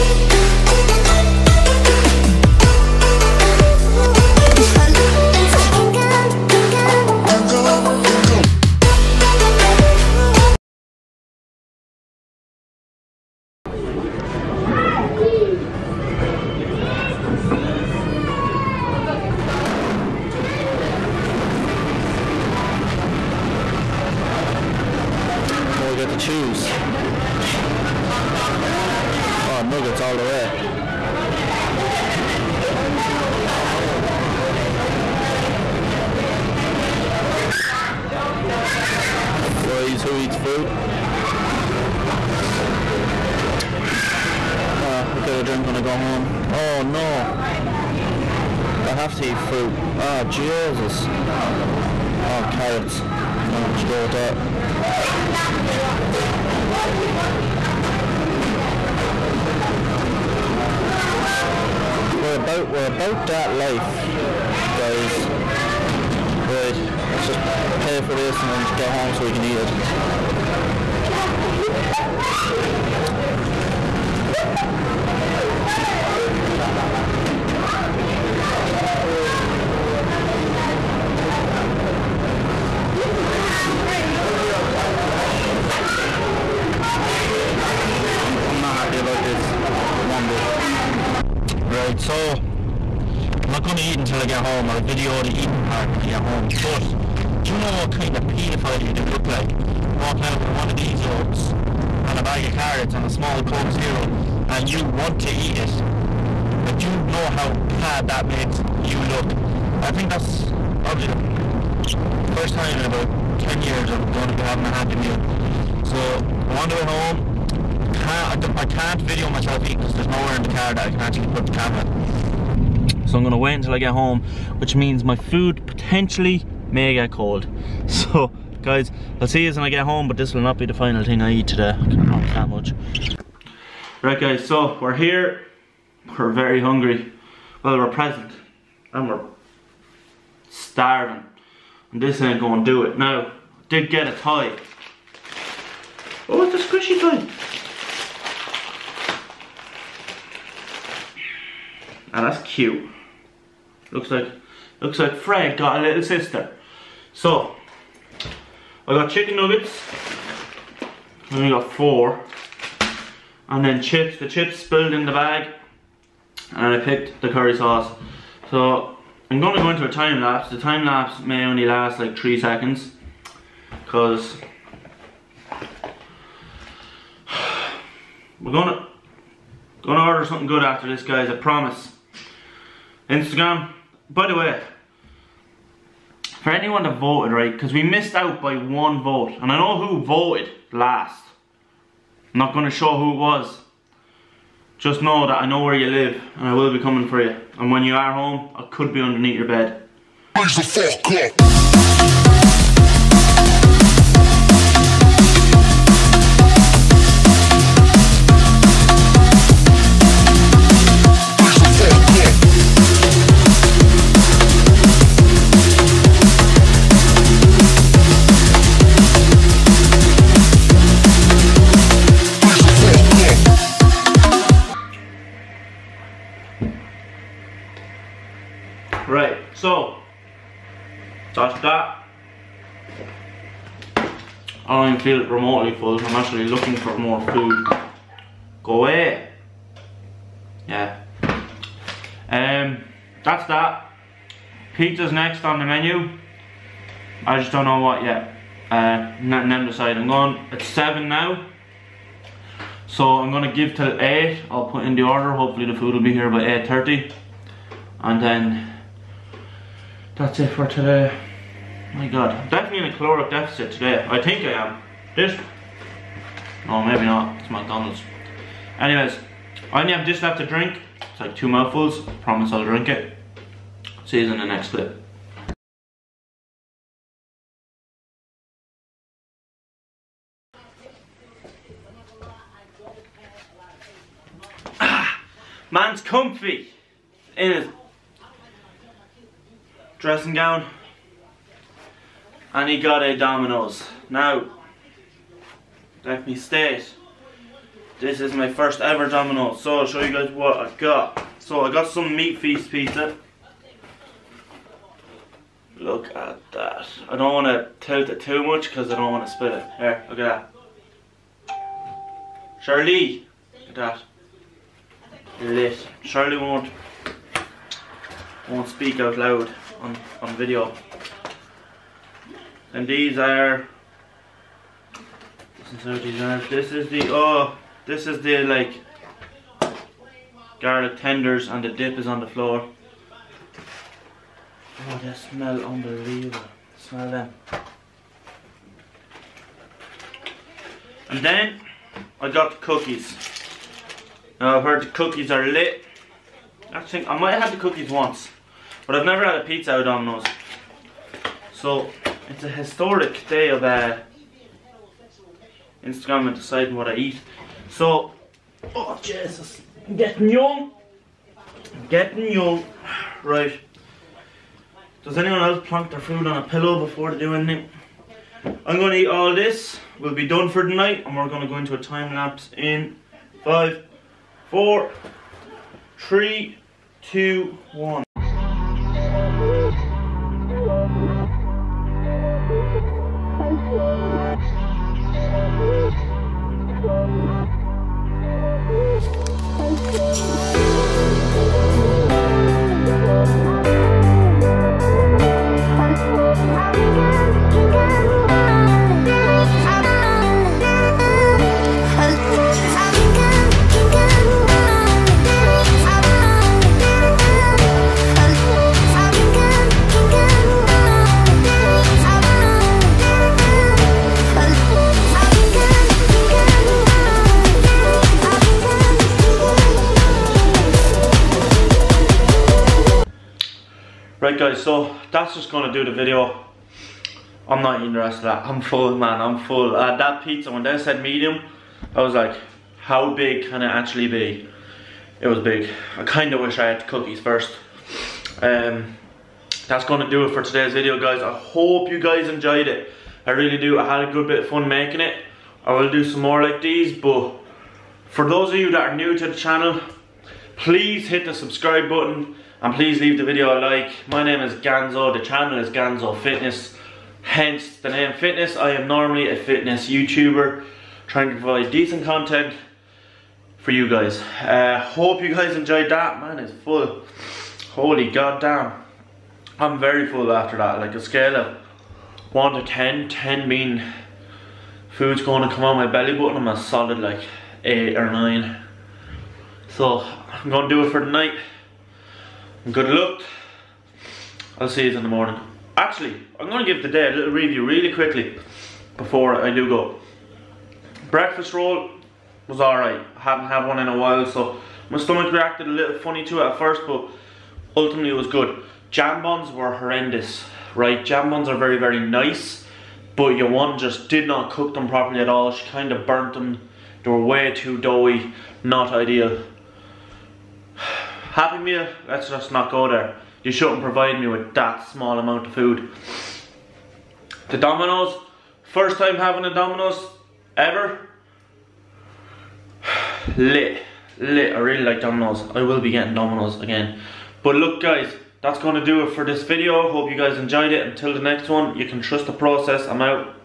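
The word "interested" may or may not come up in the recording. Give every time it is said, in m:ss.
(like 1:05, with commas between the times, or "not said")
7:07.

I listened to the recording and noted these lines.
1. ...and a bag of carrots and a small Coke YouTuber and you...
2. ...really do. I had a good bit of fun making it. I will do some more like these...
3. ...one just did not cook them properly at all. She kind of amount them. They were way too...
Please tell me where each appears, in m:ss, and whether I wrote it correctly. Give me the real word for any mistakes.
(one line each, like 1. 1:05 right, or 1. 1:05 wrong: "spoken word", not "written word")
1. 1:42 wrong: "Zero", not "YouTuber"
2. 7:23 right
3. 8:23 wrong: "burnt", not "amount".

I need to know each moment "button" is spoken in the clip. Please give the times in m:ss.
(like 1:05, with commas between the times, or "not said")
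7:31, 7:56.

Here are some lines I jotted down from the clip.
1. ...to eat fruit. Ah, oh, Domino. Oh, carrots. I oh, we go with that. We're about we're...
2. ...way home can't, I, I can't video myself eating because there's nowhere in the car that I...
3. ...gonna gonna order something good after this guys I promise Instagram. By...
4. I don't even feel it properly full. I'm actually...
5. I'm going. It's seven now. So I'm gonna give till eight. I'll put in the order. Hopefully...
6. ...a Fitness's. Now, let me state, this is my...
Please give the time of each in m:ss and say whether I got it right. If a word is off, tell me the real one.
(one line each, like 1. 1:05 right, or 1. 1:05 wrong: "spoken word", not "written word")
1. 0:49 wrong: "Jesus", not "Domino"
2. 1:56 right
3. 2:58 right
4. 3:54 wrong: "remotely", not "properly"
5. 4:09 right
6. 4:53 wrong: "Domino", not "Fitness".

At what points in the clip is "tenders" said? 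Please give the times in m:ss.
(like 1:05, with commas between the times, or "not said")
5:30.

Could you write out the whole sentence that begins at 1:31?
Right, so I'm not gonna eat until I get home.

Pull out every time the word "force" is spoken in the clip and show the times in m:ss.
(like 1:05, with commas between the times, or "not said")
not said.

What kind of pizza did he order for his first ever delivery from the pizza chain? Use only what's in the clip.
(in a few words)
Meat feast.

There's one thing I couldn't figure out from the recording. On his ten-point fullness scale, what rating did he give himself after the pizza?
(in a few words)
8 or 9.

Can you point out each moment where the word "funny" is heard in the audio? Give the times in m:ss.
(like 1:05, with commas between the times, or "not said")
8:15.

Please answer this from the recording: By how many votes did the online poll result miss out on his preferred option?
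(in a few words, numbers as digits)
1.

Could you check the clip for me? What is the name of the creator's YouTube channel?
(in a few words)
Ganzo Fitness.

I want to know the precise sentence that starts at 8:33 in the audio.
You shouldn't provide me with that small amount of food.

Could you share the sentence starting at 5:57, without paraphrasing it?
So, oh Jesus, I'm getting young, I'm getting young.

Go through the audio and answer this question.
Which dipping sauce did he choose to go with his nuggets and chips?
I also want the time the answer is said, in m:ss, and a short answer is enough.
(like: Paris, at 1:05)
Curry sauce, at 2:47.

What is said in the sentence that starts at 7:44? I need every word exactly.
Uh, hope you guys enjoyed that.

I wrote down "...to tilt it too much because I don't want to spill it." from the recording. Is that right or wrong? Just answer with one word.
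right.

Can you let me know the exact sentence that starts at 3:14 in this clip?
Just know that I know where you live, and I will be coming for you.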